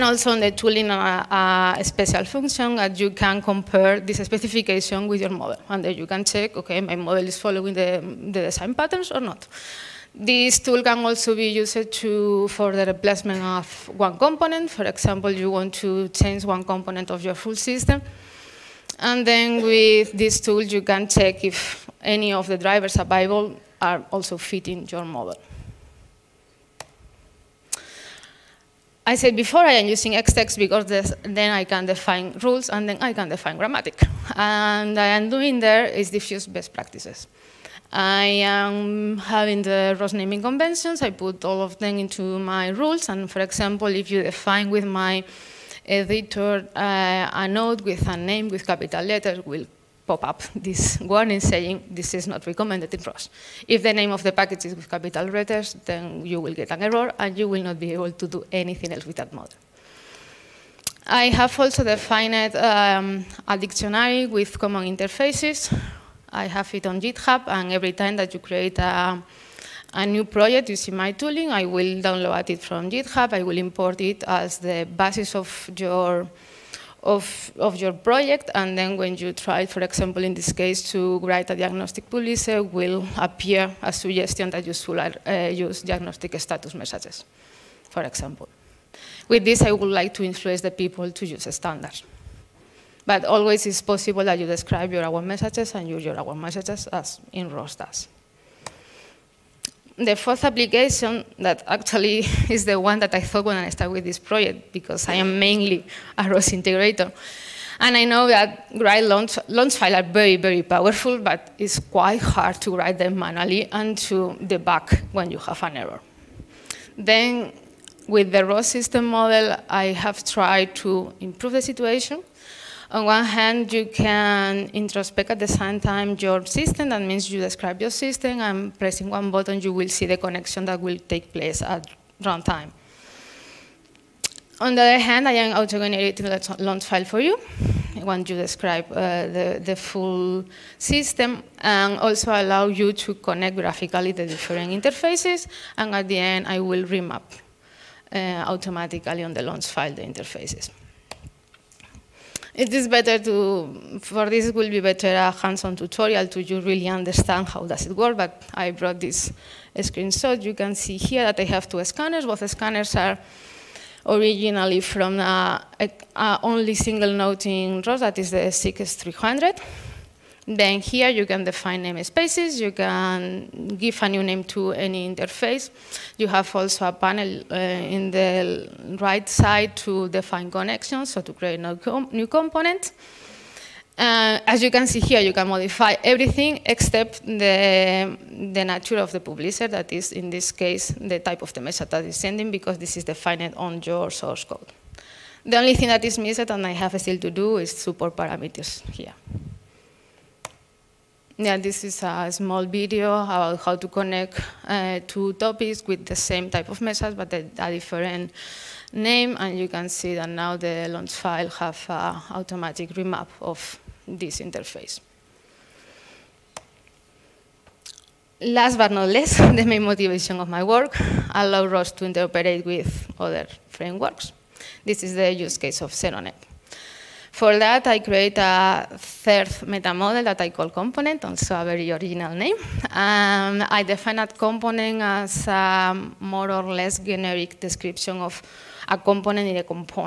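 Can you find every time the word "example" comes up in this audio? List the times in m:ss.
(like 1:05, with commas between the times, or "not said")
0:14, 0:43, 1:19, 1:28.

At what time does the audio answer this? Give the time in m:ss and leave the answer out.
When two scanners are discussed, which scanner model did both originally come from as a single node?
2:48.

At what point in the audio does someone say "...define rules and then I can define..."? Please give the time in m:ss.
0:31.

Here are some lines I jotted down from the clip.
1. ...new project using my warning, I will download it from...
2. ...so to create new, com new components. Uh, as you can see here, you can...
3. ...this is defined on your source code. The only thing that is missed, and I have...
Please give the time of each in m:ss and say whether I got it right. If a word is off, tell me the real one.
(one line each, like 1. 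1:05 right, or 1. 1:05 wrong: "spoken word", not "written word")
1. 1:10 wrong: "tooling", not "warning"
2. 3:01 right
3. 3:12 right.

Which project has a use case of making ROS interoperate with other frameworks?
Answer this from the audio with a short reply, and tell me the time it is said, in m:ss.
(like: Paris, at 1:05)
SeRoNet, at 3:45.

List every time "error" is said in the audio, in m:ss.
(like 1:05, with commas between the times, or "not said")
0:56, 1:55.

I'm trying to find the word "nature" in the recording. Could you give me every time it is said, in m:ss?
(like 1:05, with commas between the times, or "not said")
3:08.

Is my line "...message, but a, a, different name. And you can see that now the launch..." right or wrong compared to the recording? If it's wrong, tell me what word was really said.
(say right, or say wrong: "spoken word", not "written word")
right.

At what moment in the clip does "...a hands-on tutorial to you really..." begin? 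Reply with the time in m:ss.
2:35.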